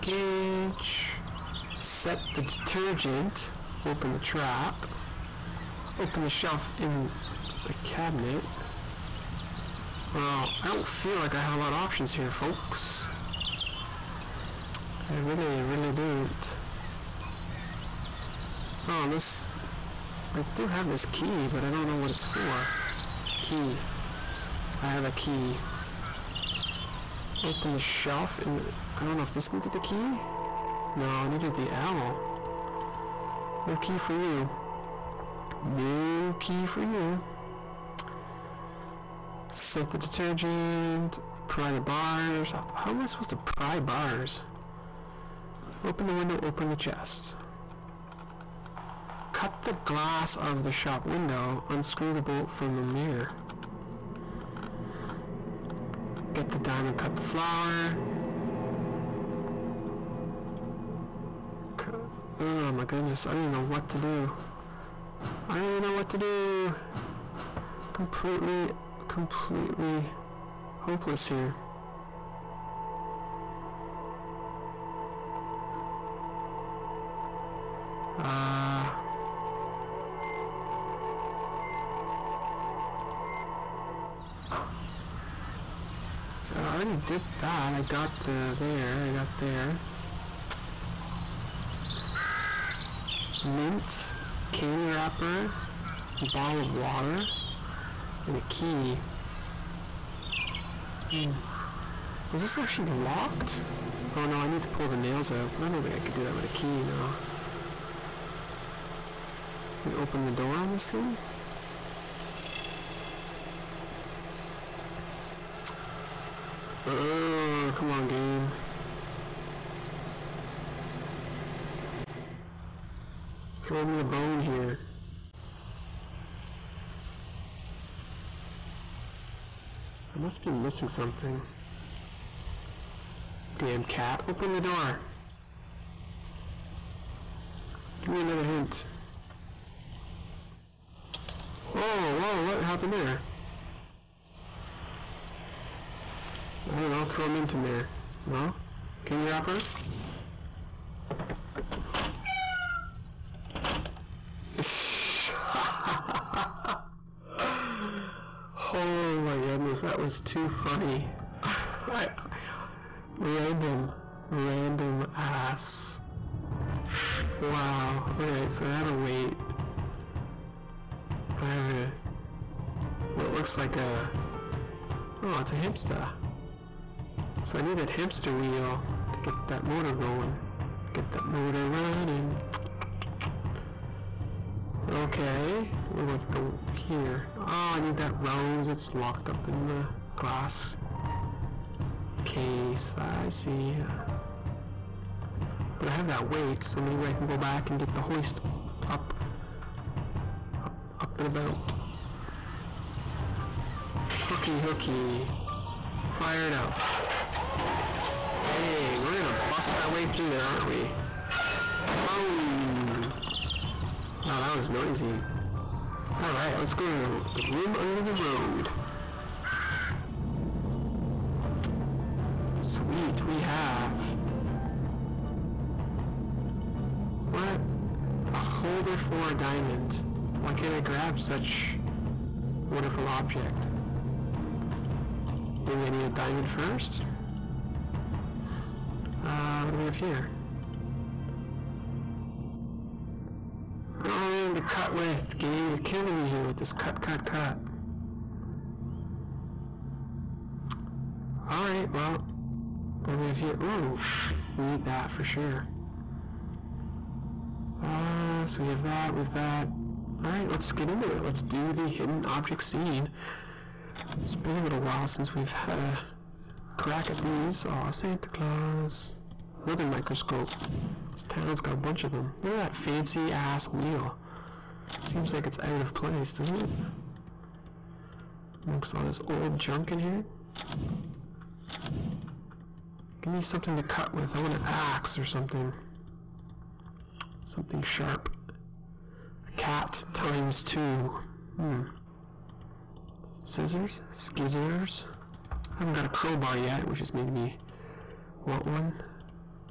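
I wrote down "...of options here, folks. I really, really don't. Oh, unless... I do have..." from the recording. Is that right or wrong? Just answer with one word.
right.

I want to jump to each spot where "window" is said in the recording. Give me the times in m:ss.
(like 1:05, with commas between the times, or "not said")
0:46, 0:51.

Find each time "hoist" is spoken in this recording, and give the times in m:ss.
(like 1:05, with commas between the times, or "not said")
3:18.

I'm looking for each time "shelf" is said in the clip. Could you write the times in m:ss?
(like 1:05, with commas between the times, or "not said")
0:06, 0:27.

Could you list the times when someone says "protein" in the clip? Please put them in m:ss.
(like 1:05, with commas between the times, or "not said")
not said.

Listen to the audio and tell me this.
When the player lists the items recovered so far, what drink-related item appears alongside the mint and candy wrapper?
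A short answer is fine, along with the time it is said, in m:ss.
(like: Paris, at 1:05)
bottle of water, at 1:36.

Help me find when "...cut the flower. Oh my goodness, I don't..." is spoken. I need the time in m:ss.
0:56.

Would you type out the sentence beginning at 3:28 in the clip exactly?
Dang, we're gonna bust our way through there, aren't we?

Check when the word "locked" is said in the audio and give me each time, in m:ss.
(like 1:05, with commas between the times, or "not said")
1:42, 3:08.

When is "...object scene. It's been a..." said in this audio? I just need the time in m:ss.
4:22.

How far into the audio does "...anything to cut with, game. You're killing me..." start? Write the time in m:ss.
4:04.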